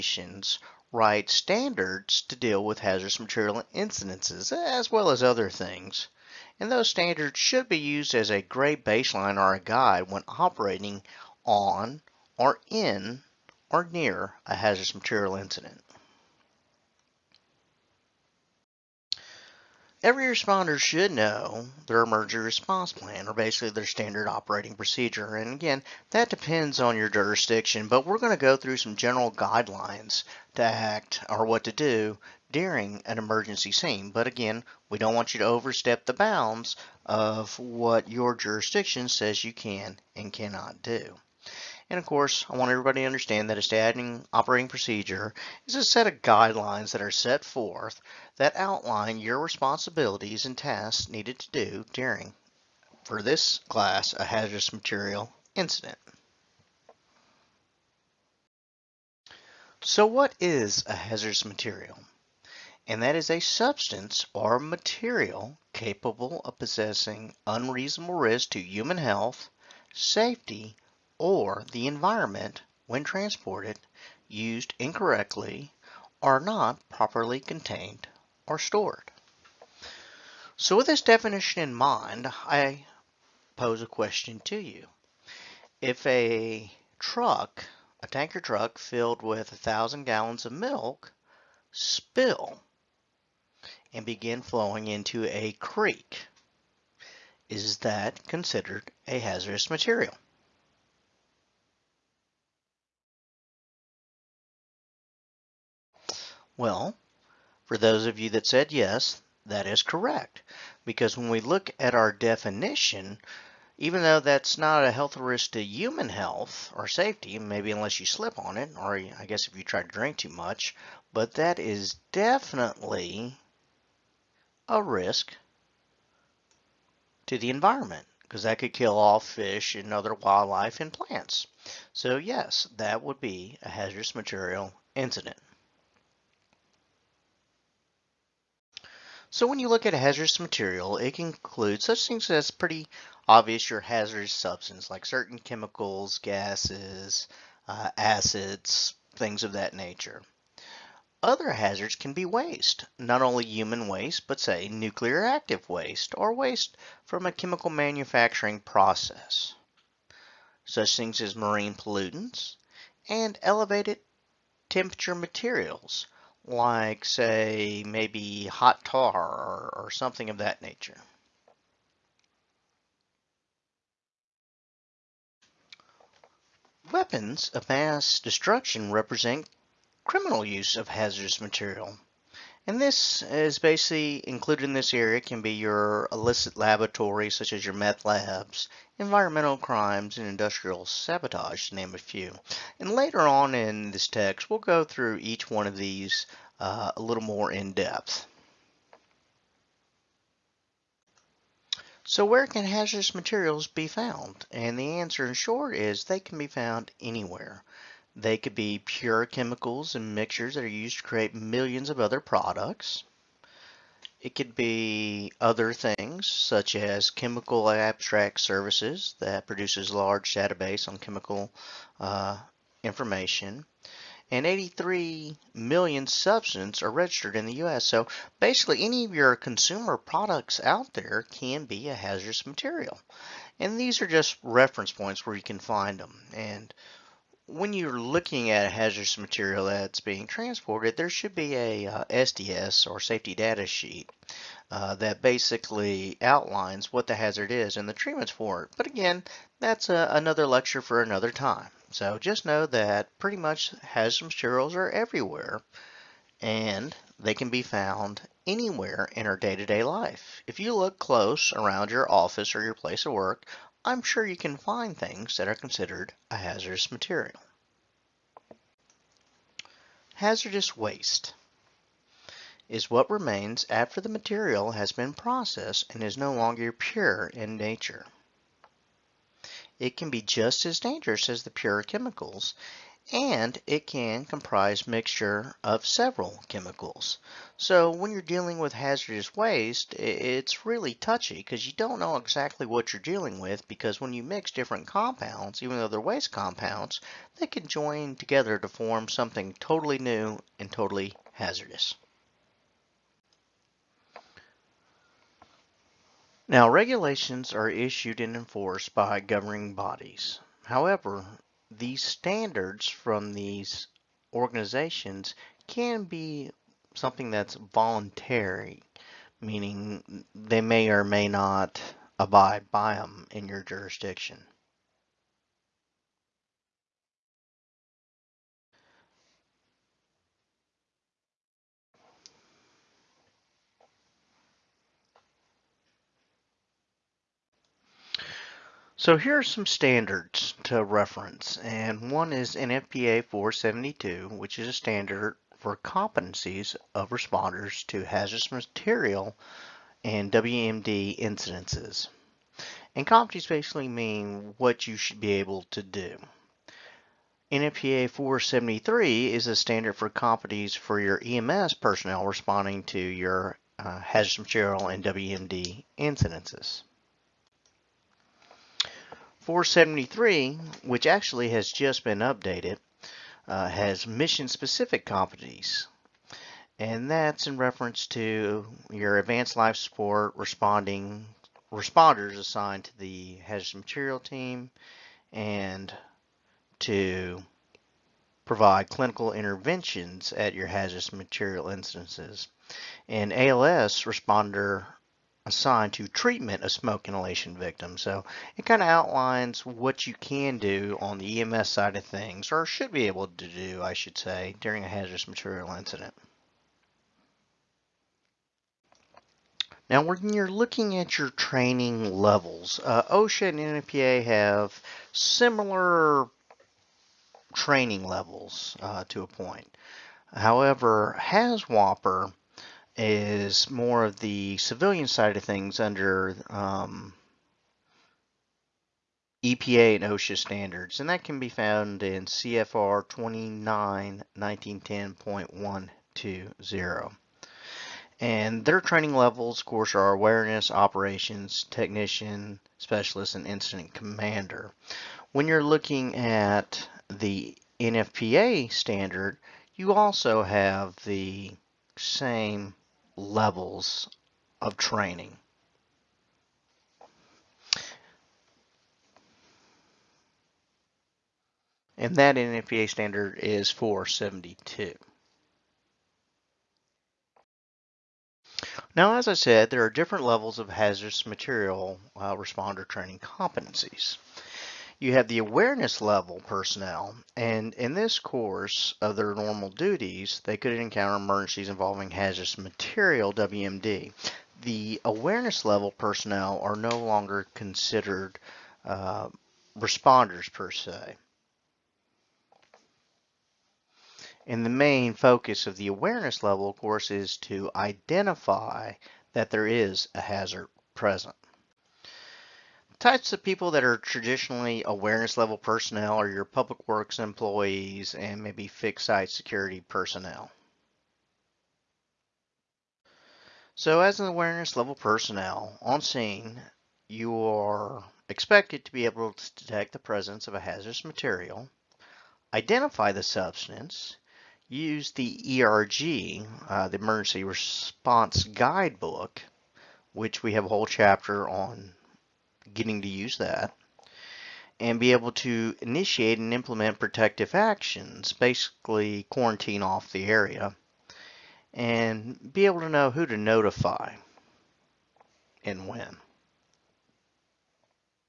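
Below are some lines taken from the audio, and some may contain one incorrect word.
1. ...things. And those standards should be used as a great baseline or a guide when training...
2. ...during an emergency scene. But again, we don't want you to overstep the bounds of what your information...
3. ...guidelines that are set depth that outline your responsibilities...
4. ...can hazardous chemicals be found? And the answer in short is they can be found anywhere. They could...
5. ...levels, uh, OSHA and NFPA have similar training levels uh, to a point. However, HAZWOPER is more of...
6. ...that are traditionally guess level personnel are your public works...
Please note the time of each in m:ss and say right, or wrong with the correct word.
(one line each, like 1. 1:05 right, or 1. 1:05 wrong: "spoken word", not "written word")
1. 0:05 wrong: "operating", not "training"
2. 0:32 wrong: "jurisdiction", not "information"
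3. 0:46 wrong: "forth", not "depth"
4. 3:22 wrong: "materials", not "chemicals"
5. 6:52 right
6. 8:23 wrong: "awareness", not "guess".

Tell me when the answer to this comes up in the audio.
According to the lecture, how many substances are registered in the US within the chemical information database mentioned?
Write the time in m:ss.
3:44.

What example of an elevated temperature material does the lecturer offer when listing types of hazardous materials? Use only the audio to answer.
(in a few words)
hot tar.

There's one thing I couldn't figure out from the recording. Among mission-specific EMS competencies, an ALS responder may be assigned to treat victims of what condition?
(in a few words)
smoke inhalation.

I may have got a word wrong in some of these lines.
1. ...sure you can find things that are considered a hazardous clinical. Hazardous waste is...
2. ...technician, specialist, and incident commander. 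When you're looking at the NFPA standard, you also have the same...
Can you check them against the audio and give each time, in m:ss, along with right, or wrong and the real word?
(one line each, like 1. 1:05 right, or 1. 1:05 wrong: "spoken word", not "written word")
1. 4:24 wrong: "material", not "clinical"
2. 7:21 right.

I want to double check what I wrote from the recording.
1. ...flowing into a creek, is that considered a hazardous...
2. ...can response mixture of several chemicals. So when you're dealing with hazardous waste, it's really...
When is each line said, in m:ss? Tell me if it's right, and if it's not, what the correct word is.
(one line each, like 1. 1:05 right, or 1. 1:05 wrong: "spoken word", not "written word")
1. 1:34 right
2. 4:43 wrong: "comprise", not "response".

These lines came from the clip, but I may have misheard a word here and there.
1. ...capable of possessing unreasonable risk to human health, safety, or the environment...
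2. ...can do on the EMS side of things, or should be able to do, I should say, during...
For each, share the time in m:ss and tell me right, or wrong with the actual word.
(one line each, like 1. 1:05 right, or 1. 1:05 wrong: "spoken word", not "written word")
1. 1:05 right
2. 6:40 right.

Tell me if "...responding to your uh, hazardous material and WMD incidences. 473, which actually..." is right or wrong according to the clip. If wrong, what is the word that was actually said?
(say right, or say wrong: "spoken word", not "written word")
right.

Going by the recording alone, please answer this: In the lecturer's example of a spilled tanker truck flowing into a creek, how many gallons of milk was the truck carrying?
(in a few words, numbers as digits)
1000.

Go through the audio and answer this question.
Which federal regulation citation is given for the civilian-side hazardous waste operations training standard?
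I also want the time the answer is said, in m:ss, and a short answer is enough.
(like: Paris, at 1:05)
CFR 29 1910.120, at 7:12.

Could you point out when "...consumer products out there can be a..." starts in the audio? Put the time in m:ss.
3:49.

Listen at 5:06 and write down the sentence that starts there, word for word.
Now regulations are issued and enforced by governing bodies.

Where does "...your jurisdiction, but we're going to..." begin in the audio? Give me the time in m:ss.
0:26.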